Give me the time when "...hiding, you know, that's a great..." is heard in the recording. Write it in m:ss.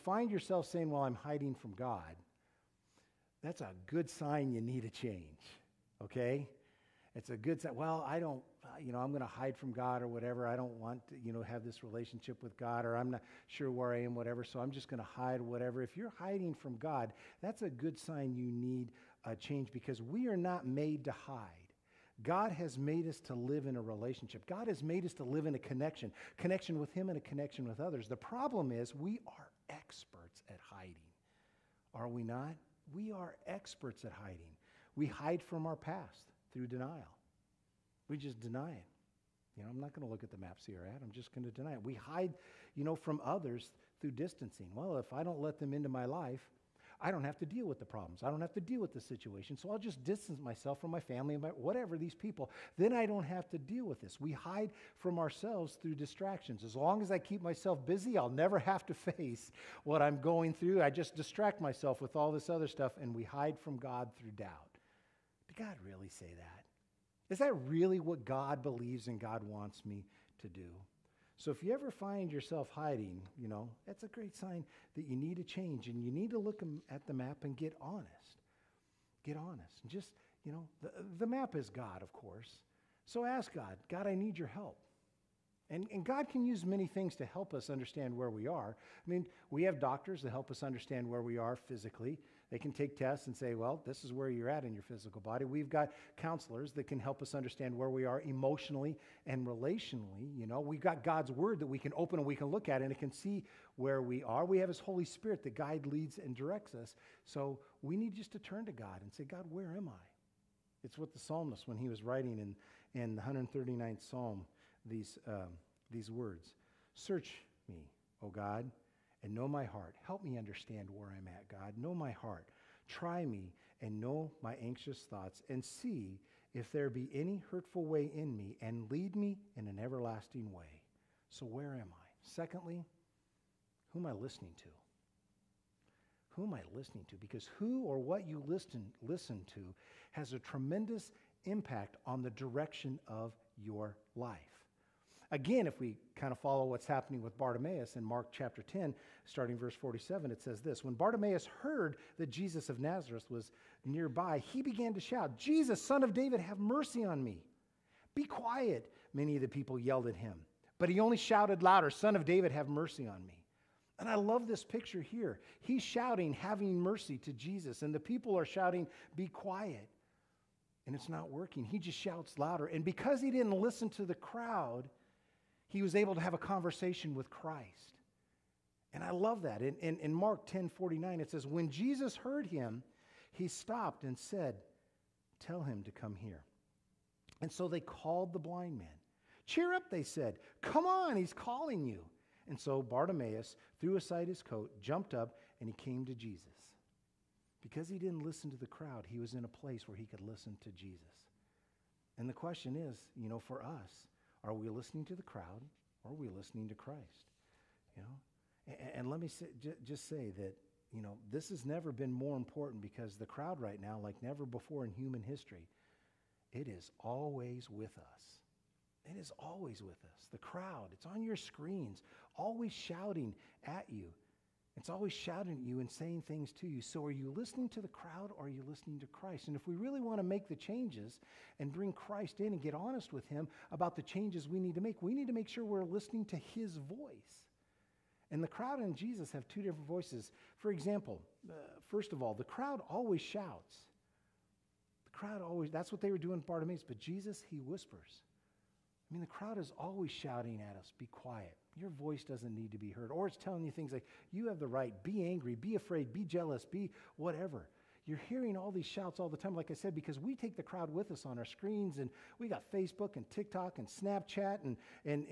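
1:12.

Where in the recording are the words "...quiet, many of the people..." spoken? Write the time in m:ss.
2:38.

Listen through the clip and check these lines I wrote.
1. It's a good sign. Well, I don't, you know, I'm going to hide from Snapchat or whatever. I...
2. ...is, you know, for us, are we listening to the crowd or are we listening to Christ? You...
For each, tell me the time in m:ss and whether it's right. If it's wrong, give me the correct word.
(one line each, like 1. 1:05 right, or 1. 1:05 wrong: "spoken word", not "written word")
1. 0:07 wrong: "God", not "Snapchat"
2. 3:22 right.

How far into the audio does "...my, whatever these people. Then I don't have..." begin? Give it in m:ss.
0:51.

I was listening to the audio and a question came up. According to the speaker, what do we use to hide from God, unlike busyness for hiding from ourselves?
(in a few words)
Doubt.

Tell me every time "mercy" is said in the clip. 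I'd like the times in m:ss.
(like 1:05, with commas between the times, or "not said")
2:36, 2:42, 2:46.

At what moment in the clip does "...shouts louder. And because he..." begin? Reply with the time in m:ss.
2:51.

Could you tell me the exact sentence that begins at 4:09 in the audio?
I mean, the crowd is always shouting at us, be quiet your voice doesn't need to be heard.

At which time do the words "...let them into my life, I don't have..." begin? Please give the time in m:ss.
0:45.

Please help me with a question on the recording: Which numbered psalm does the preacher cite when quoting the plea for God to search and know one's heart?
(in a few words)
139th.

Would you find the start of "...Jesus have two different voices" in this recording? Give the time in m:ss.
3:58.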